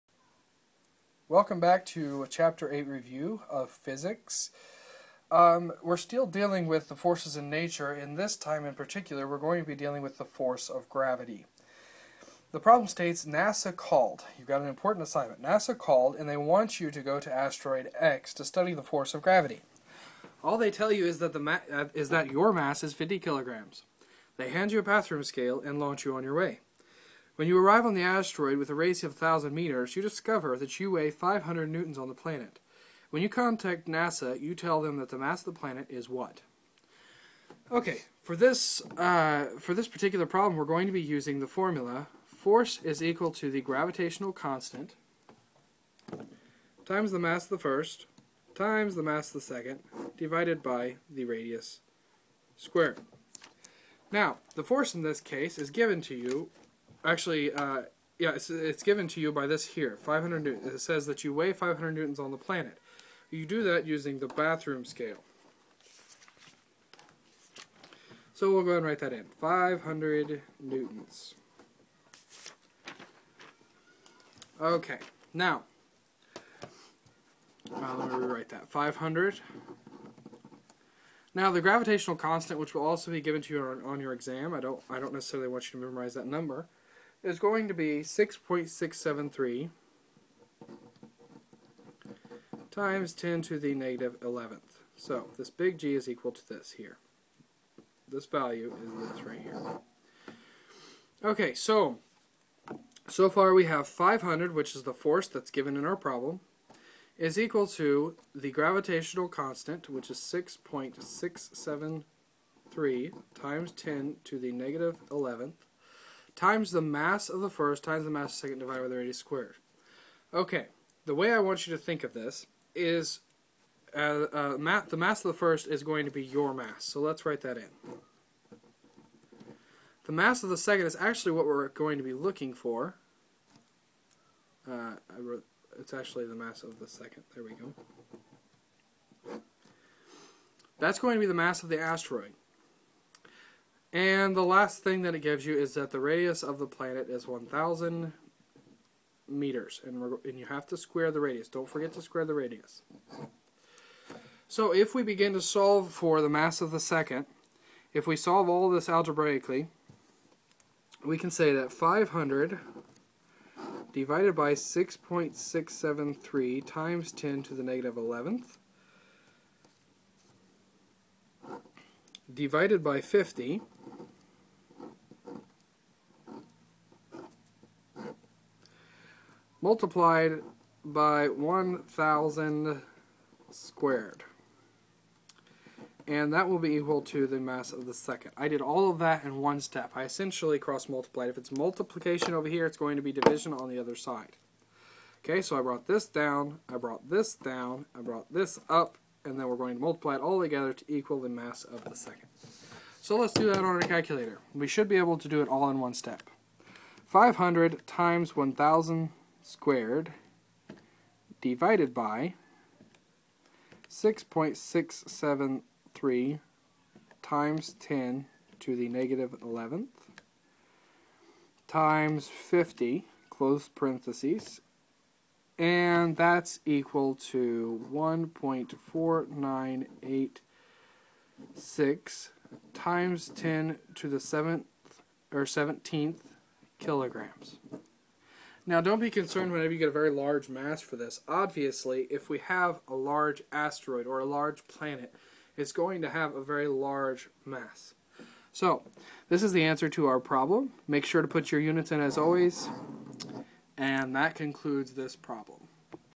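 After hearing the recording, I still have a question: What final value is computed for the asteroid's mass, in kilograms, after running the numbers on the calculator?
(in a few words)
1.4986 x 10^17 kilograms.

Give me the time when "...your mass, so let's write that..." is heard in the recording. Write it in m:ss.
2:06.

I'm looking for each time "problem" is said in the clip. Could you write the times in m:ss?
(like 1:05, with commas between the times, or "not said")
0:12, 0:40, 1:45, 4:10, 4:15.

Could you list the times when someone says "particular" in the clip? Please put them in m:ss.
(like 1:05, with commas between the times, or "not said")
0:08, 0:39.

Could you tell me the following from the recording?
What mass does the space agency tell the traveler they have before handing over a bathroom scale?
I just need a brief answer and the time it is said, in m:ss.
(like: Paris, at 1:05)
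50 kilograms, at 0:22.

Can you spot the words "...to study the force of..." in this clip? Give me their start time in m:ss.
0:18.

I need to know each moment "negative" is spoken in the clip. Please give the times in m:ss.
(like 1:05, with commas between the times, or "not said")
1:33, 1:54, 2:47, 3:38.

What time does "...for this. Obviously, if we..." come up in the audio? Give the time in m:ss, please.
4:00.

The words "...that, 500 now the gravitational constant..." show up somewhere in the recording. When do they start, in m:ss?
1:18.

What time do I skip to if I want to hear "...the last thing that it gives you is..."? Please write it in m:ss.
2:24.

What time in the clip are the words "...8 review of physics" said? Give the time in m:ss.
0:02.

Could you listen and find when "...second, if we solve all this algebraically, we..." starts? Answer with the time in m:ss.
2:36.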